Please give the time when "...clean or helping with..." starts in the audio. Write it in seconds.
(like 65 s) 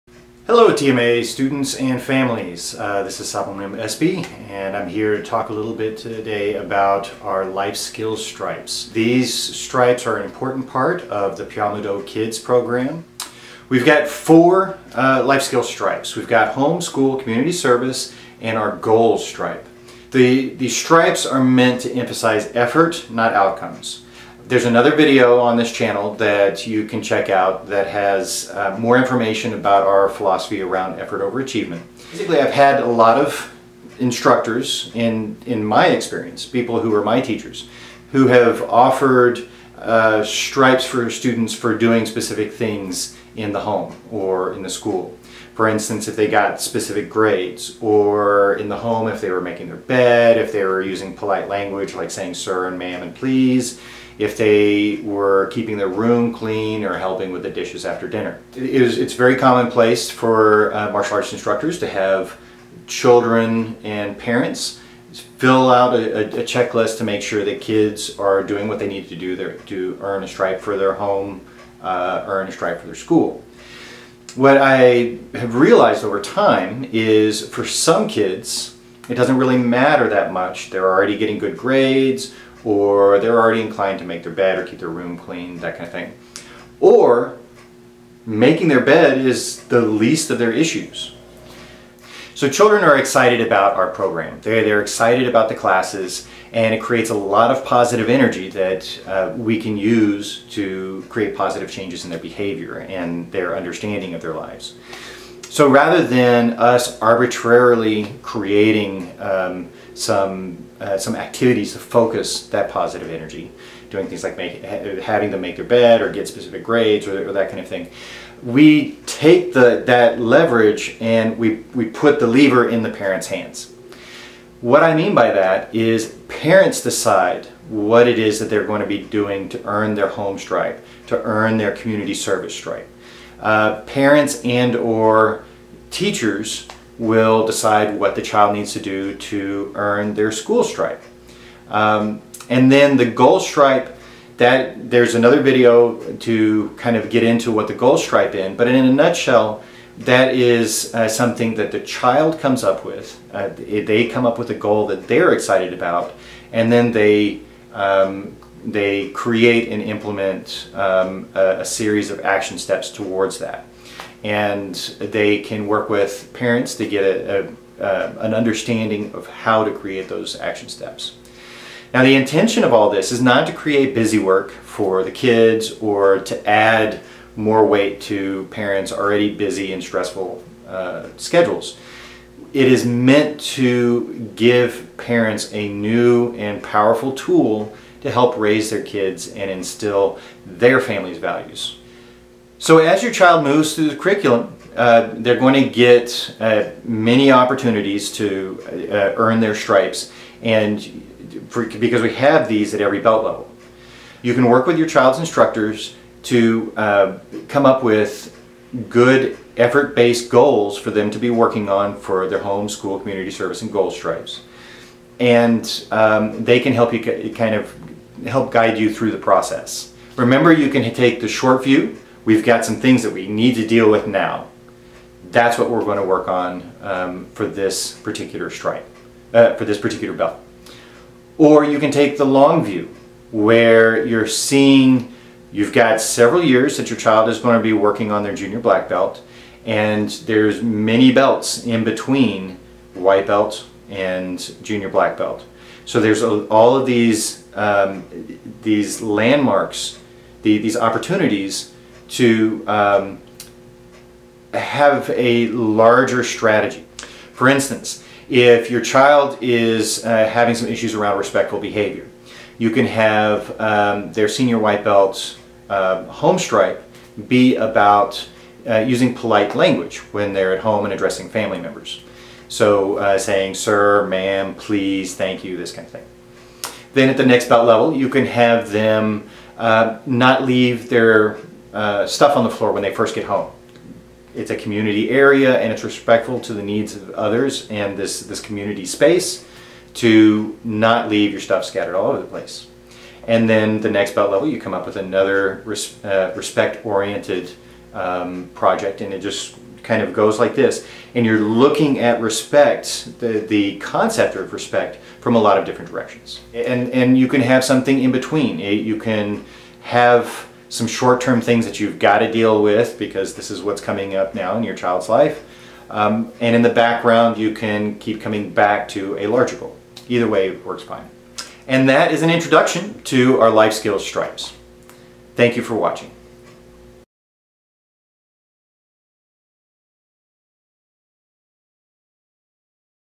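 56 s.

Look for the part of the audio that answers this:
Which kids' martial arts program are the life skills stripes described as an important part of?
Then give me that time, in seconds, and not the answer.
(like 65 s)
11 s.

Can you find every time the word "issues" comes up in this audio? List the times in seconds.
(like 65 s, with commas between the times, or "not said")
90 s, 260 s.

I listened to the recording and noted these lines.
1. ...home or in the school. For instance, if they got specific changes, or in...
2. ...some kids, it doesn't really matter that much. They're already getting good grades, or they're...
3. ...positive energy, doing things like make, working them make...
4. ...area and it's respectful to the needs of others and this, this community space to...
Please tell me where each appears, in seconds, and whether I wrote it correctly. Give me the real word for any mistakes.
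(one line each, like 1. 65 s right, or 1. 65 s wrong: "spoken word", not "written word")
1. 43 s wrong: "grades", not "changes"
2. 77 s right
3. 112 s wrong: "having", not "working"
4. 285 s right.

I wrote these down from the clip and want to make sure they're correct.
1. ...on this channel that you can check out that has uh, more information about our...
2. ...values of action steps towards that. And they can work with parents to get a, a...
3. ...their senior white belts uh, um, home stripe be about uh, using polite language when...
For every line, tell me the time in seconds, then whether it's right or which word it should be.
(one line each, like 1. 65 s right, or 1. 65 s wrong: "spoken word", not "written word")
1. 25 s right
2. 161 s wrong: "series", not "values"
3. 264 s right.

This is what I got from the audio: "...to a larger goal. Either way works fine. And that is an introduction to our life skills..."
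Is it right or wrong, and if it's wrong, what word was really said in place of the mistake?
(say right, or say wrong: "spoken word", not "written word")
right.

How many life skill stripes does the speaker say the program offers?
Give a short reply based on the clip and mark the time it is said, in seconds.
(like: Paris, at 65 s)
4, at 14 s.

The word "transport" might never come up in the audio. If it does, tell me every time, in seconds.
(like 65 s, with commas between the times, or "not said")
not said.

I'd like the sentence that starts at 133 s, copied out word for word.
Uh, parents and or teachers will decide what the child needs to do to earn their school stripe.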